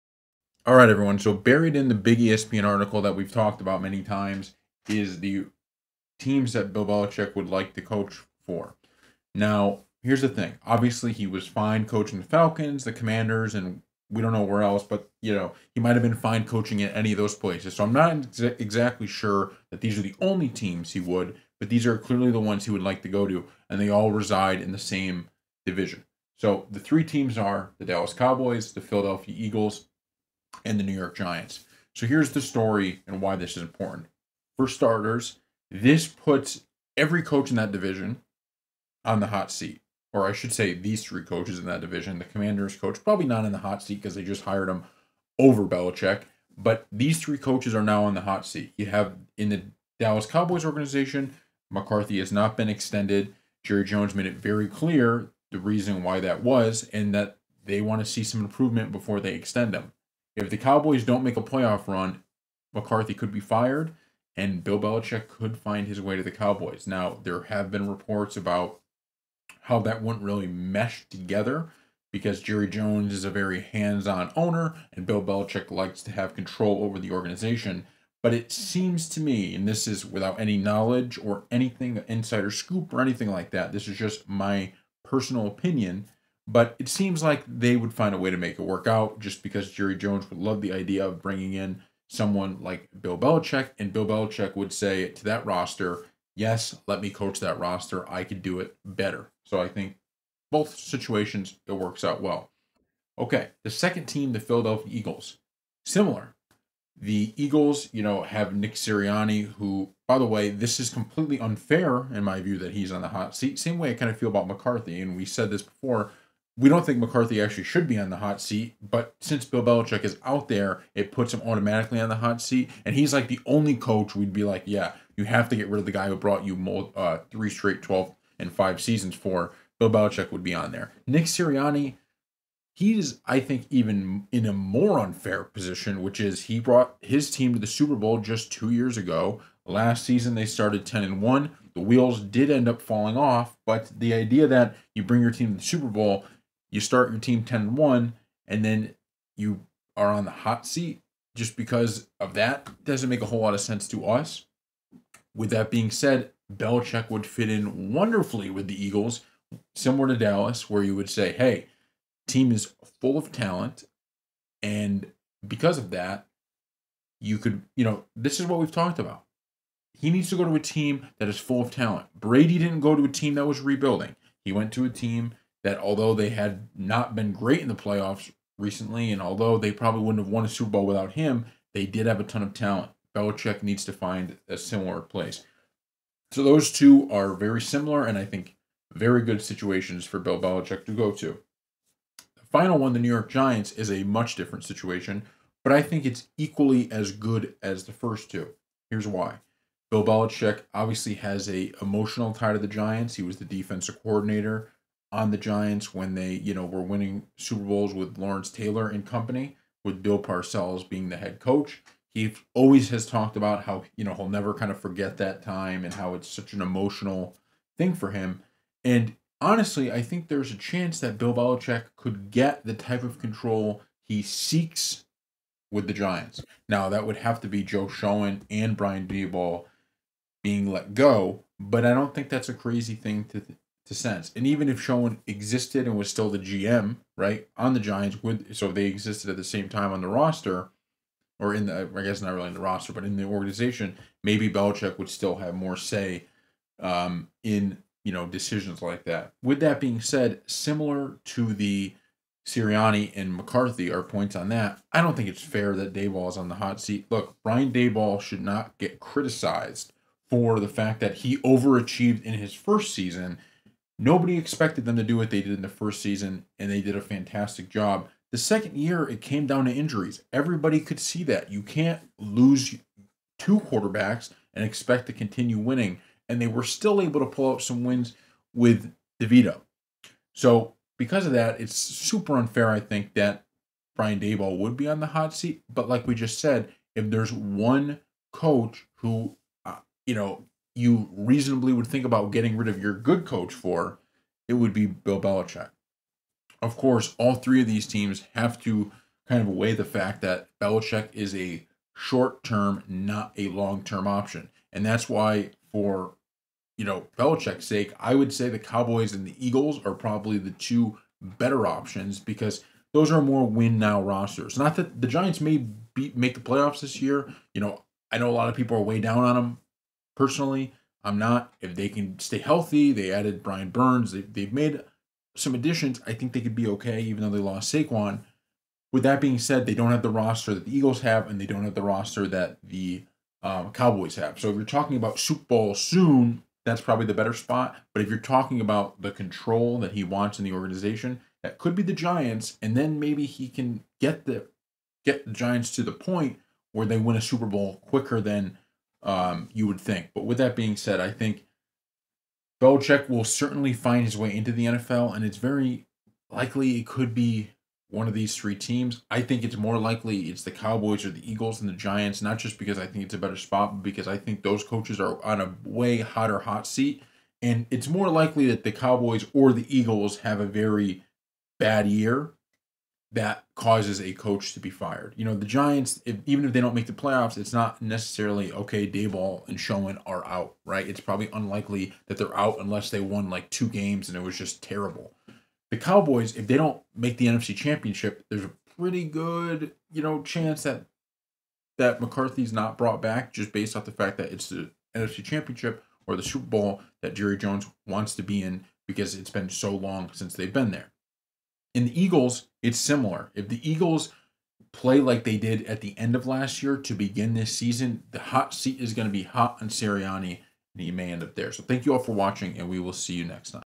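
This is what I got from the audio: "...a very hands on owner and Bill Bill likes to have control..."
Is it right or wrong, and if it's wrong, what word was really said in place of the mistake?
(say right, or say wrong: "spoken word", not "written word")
wrong: "Belichick", not "Bill".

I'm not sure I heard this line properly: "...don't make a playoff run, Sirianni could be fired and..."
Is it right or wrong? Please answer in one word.
wrong.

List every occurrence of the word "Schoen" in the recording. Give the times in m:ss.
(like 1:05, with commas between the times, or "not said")
3:47, 3:54.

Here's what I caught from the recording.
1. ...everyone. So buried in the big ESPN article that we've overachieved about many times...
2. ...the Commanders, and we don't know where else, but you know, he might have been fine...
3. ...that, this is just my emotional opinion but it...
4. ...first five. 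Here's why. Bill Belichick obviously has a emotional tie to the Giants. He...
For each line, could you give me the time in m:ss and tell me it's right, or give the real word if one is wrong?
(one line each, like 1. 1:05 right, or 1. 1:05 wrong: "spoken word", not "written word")
1. 0:00 wrong: "talked", not "overachieved"
2. 0:12 right
3. 1:23 wrong: "personal", not "emotional"
4. 3:17 wrong: "two", not "five".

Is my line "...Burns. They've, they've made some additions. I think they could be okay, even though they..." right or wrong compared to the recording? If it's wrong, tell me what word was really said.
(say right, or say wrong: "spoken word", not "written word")
right.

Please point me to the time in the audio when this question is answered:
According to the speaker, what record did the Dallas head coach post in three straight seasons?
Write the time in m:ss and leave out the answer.
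2:07.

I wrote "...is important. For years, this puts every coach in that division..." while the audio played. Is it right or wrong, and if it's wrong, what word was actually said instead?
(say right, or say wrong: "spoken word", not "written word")
wrong: "starters", not "years".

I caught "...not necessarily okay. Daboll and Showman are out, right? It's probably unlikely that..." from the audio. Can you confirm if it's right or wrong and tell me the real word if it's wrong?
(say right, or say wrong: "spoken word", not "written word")
right.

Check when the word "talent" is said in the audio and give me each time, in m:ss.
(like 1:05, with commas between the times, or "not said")
2:43, 2:51, 3:02.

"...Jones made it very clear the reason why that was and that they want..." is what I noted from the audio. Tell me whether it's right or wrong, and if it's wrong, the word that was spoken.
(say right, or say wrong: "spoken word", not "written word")
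right.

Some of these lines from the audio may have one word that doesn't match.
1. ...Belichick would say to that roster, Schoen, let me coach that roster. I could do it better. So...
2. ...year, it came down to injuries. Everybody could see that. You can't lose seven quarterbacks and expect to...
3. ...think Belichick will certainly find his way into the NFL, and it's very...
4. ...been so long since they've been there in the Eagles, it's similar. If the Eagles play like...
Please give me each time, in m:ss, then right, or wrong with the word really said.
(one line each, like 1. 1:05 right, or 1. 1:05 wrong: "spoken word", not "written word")
1. 1:34 wrong: "Yes", not "Schoen"
2. 4:28 wrong: "two", not "seven"
3. 5:51 right
4. 6:39 right.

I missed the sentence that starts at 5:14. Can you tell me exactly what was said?
Not that the Giants may be, make the playoffs this year.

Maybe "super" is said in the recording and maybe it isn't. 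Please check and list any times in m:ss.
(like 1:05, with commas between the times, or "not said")
2:17, 2:25, 3:00, 3:27, 4:41, 5:35, 5:47, 6:36.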